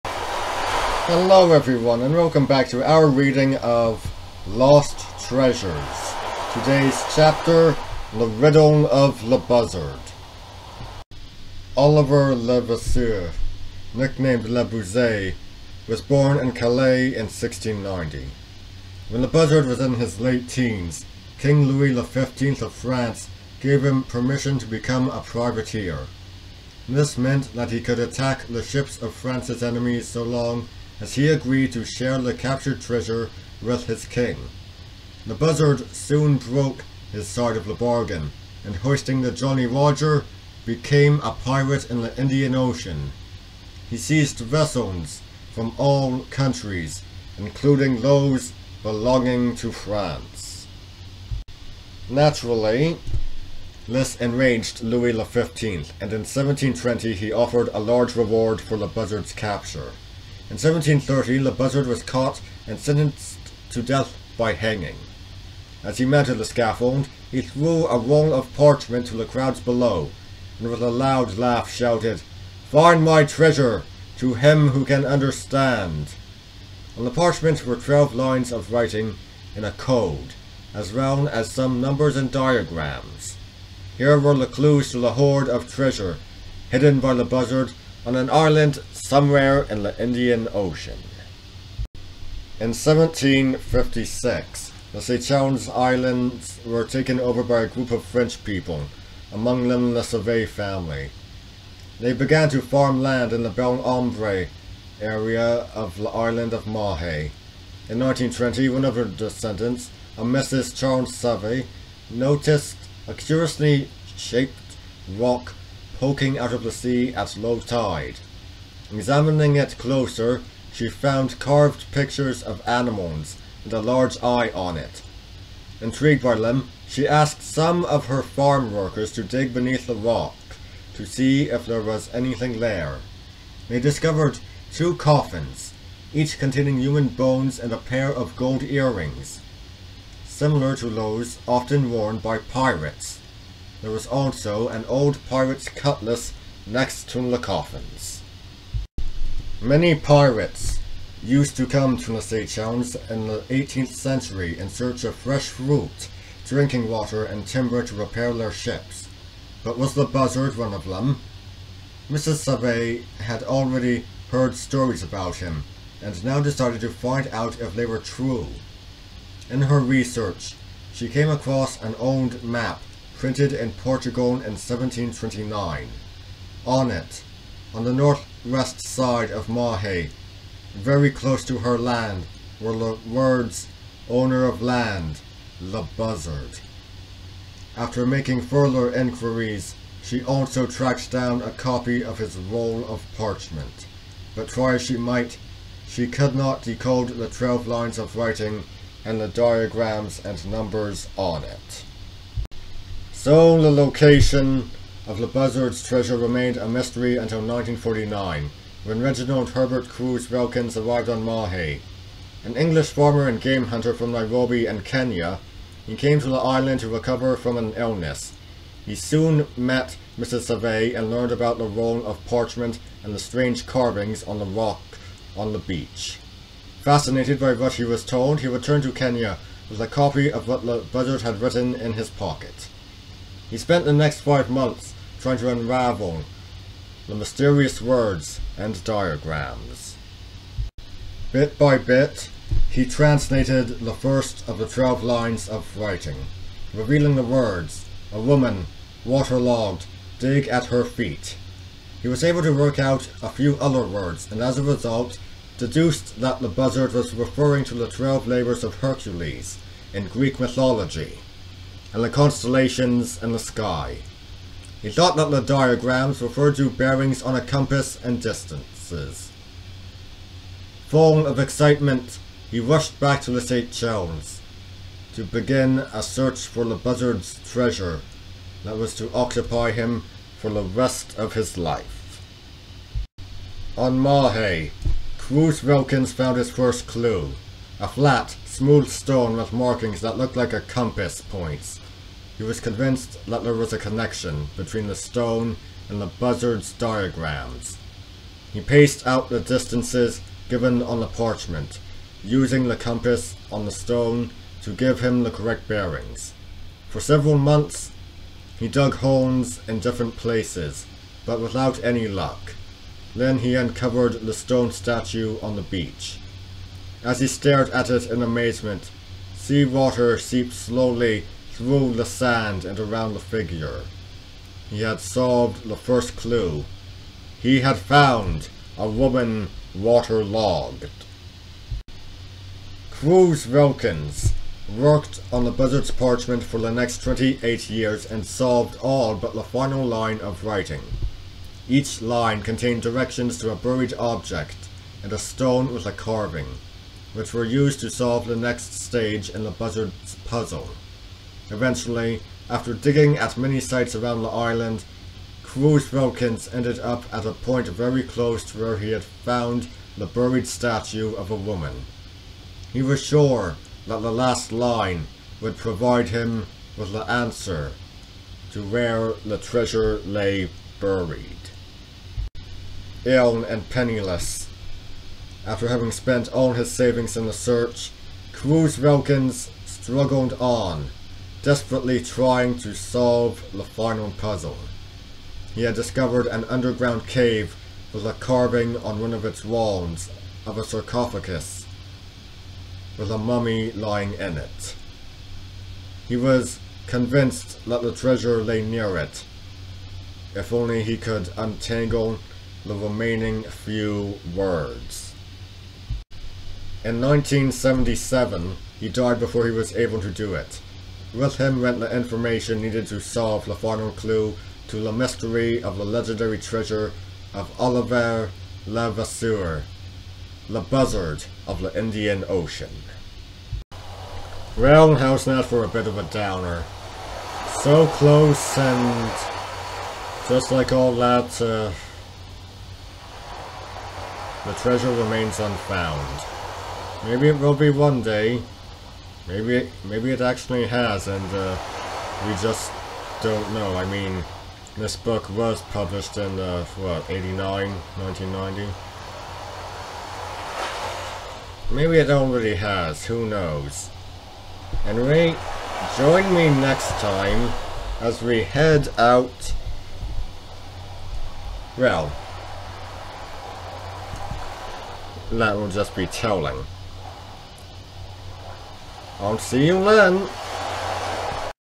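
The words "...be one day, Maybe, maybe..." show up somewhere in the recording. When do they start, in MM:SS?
07:17.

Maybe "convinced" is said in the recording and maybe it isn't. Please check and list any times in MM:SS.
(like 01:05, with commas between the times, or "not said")
04:52, 06:36.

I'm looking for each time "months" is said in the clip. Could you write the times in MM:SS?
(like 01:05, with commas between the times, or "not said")
03:54, 05:07.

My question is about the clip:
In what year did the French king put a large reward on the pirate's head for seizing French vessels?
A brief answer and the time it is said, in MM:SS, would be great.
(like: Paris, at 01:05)
1720, at 00:56.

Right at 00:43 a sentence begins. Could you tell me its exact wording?
He seized vessels from all countries, including those belonging to France.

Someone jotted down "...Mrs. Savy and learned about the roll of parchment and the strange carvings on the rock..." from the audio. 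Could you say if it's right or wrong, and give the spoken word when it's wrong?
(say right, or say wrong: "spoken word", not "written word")
right.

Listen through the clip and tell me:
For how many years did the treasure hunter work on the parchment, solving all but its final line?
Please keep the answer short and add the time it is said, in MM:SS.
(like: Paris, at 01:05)
28, at 05:37.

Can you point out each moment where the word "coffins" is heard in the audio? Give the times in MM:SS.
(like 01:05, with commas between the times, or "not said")
02:14, 02:27.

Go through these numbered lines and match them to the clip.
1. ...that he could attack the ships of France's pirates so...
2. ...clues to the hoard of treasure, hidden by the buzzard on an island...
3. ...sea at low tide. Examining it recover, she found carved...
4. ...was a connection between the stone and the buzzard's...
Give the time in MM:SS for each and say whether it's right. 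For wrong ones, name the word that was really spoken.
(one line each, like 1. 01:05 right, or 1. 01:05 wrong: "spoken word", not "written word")
1. 00:27 wrong: "enemies", not "pirates"
2. 01:24 right
3. 01:56 wrong: "closer", not "recover"
4. 04:53 right.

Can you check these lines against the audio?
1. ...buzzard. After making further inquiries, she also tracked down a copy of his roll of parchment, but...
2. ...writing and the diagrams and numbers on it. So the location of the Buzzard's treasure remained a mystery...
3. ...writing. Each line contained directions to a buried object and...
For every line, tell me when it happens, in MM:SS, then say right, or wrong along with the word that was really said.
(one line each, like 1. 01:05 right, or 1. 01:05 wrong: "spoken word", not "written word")
1. 03:05 right
2. 03:18 right
3. 05:40 right.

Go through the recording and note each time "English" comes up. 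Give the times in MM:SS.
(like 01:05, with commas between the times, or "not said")
03:32.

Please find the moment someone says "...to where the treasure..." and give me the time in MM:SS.
06:08.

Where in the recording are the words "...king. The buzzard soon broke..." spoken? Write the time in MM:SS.
00:34.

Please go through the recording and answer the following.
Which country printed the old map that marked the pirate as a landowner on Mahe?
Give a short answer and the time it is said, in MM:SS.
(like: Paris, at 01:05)
Portugal, at 02:53.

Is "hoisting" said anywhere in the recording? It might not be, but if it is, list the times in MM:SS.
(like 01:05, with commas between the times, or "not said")
00:38.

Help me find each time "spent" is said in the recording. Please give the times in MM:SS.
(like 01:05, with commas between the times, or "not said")
03:53, 06:15.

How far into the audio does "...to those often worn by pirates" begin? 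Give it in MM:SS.
02:20.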